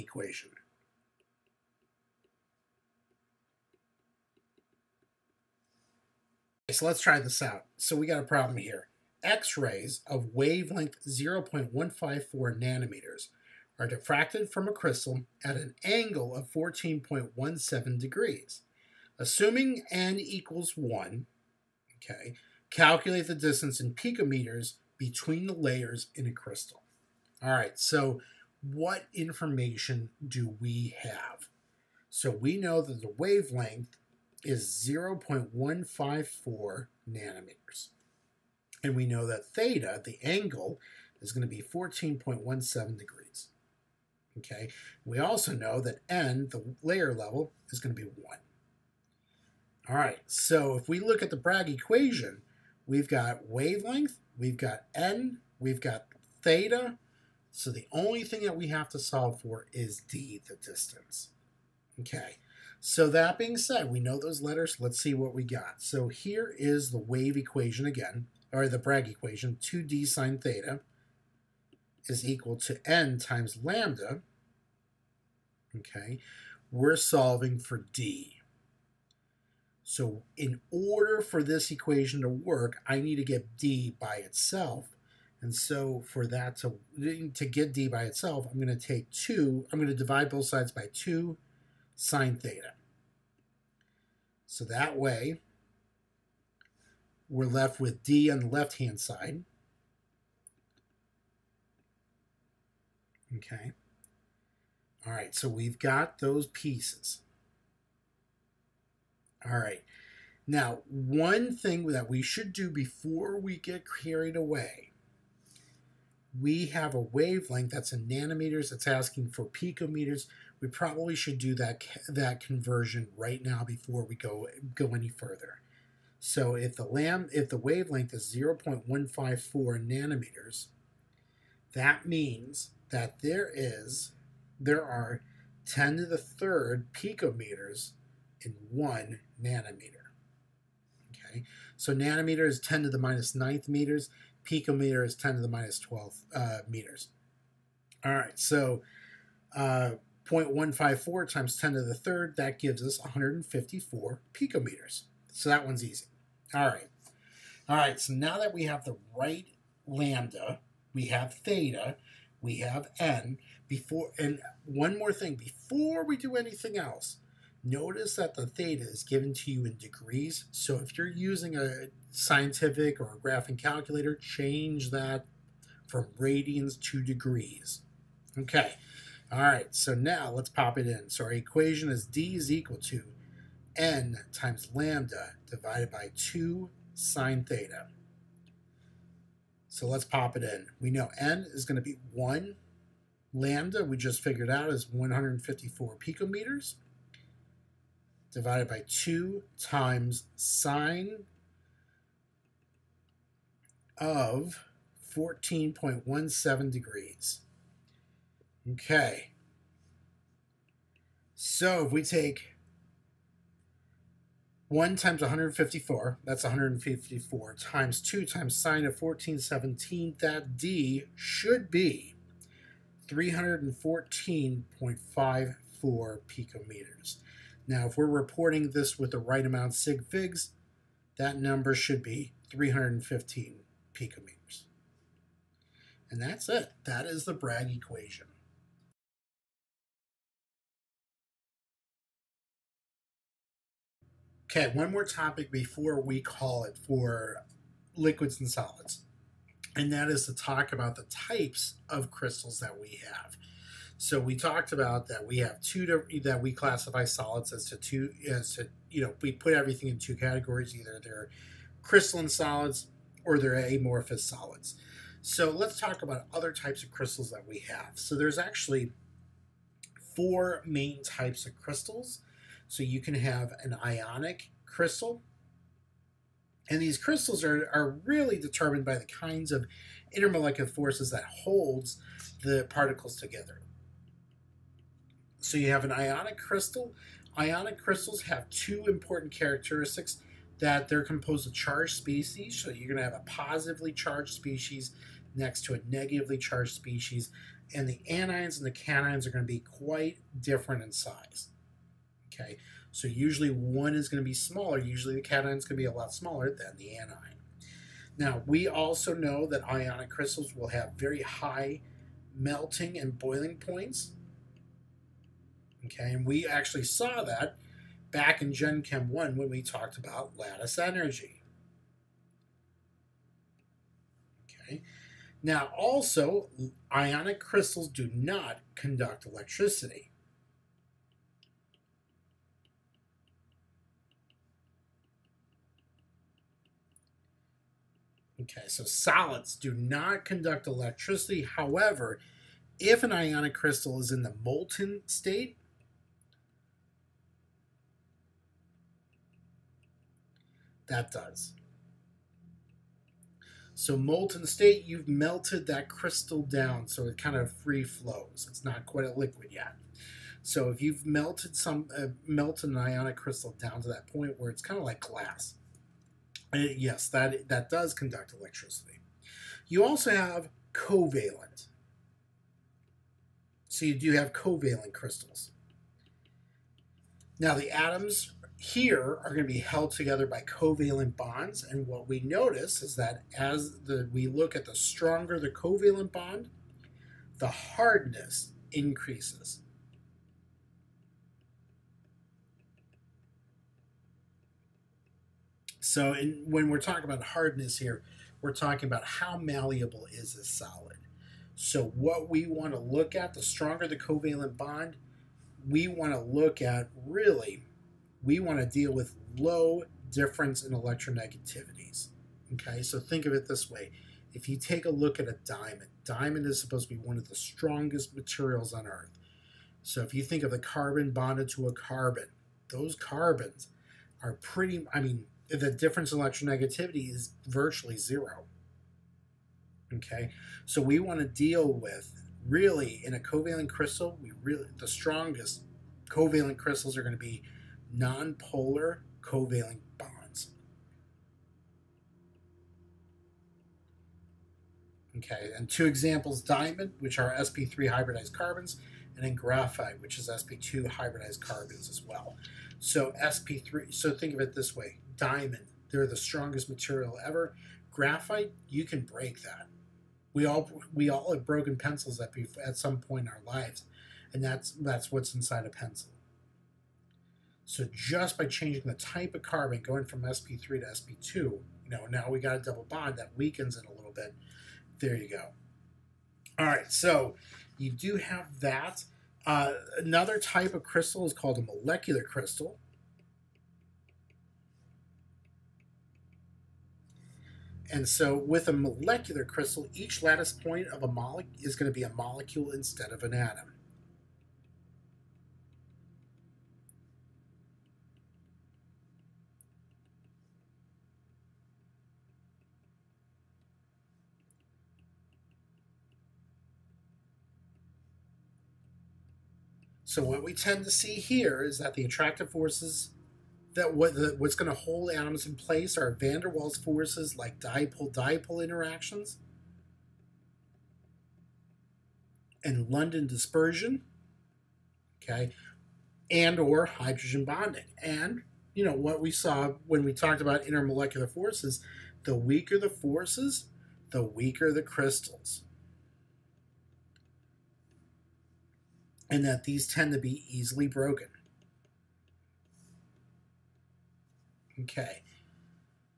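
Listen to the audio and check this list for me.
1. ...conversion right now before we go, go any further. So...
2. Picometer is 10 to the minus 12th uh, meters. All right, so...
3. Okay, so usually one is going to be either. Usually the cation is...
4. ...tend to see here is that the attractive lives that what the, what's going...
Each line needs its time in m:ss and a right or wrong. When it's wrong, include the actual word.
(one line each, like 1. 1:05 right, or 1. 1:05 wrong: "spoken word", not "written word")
1. 2:02 right
2. 2:24 right
3. 5:02 wrong: "smaller", not "either"
4. 8:30 wrong: "forces", not "lives".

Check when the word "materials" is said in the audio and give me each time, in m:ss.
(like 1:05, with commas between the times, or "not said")
6:58, 7:36.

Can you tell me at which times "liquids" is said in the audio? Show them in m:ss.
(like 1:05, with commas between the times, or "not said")
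4:07, 5:59.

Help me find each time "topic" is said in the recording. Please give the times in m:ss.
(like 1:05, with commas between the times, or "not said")
4:05.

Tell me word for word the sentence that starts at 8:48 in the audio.
And you know what we saw when we talked about intermolecular forces, the weaker the forces, the weaker the crystals.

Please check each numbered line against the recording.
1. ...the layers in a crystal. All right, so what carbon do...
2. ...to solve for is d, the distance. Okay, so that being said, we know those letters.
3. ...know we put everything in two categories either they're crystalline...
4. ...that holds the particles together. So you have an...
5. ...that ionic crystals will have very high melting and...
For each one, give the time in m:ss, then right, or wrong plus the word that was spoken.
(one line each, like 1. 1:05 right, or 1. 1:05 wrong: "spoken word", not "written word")
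1. 0:25 wrong: "information", not "carbon"
2. 0:58 right
3. 4:19 right
4. 4:41 right
5. 5:09 right.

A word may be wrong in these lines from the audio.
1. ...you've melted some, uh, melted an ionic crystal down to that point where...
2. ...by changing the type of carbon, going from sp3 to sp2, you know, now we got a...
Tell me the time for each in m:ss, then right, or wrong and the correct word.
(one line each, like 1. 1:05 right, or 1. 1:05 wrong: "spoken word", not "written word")
1. 6:00 right
2. 7:48 right.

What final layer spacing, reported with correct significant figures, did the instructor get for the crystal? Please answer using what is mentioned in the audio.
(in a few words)
315 picometers.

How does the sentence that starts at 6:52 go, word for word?
Okay, so think of it this way.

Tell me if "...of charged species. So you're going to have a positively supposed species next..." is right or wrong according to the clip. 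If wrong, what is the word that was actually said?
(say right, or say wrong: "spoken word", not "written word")
wrong: "charged", not "supposed".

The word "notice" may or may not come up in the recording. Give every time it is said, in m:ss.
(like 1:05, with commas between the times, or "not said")
2:47, 6:22.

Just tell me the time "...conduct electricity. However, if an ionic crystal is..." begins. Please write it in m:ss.
5:40.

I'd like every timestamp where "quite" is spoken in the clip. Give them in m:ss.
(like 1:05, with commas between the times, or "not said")
4:59, 5:58.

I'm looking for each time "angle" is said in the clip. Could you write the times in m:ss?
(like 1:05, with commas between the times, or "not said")
0:15, 0:40.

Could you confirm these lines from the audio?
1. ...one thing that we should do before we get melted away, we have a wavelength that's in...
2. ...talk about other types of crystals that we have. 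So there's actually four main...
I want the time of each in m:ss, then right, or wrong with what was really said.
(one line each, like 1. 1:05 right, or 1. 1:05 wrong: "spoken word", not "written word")
1. 1:50 wrong: "carried", not "melted"
2. 4:25 right.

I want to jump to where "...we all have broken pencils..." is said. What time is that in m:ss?
7:40.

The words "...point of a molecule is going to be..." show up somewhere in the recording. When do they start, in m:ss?
8:10.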